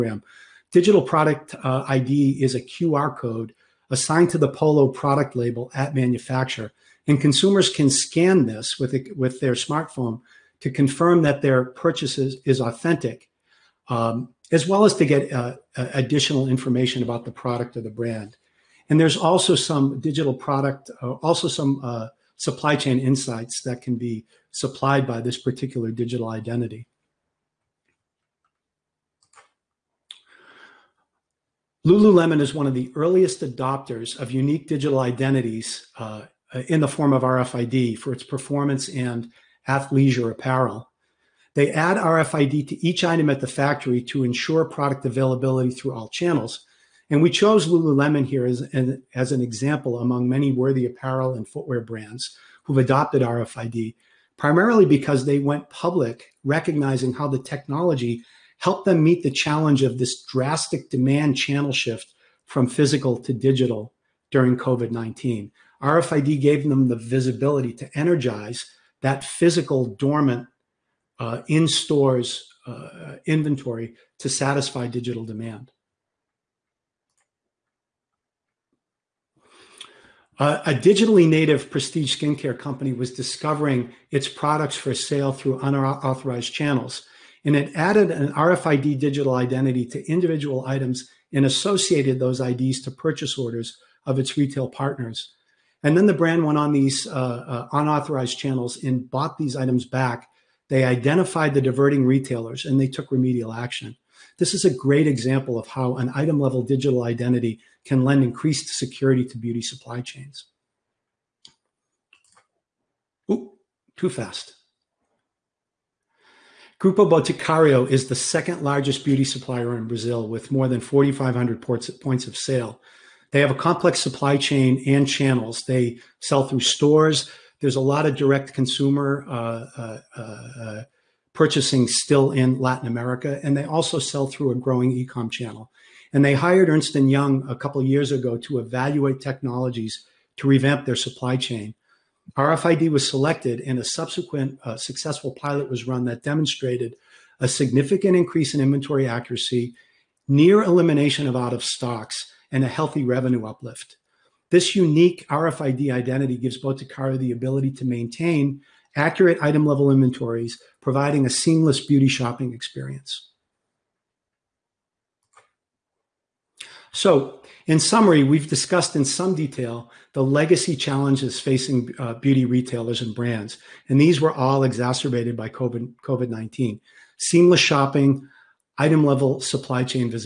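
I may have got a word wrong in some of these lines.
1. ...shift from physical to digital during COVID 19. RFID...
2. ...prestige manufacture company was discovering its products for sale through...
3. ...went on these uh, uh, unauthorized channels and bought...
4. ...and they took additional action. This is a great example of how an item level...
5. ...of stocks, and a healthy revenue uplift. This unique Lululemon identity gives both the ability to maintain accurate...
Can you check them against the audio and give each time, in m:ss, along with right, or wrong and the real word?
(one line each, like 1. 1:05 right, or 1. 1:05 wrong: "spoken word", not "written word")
1. 1:01 right
2. 1:21 wrong: "skincare", not "manufacture"
3. 1:36 right
4. 1:42 wrong: "remedial", not "additional"
5. 2:31 wrong: "RFID", not "Lululemon".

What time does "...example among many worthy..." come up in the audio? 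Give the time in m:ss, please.
0:49.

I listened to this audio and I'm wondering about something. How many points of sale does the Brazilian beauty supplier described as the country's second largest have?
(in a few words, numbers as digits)
4,500.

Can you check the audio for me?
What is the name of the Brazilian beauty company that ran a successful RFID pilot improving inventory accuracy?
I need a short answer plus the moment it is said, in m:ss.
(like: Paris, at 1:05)
Grupo Boticario, at 1:56.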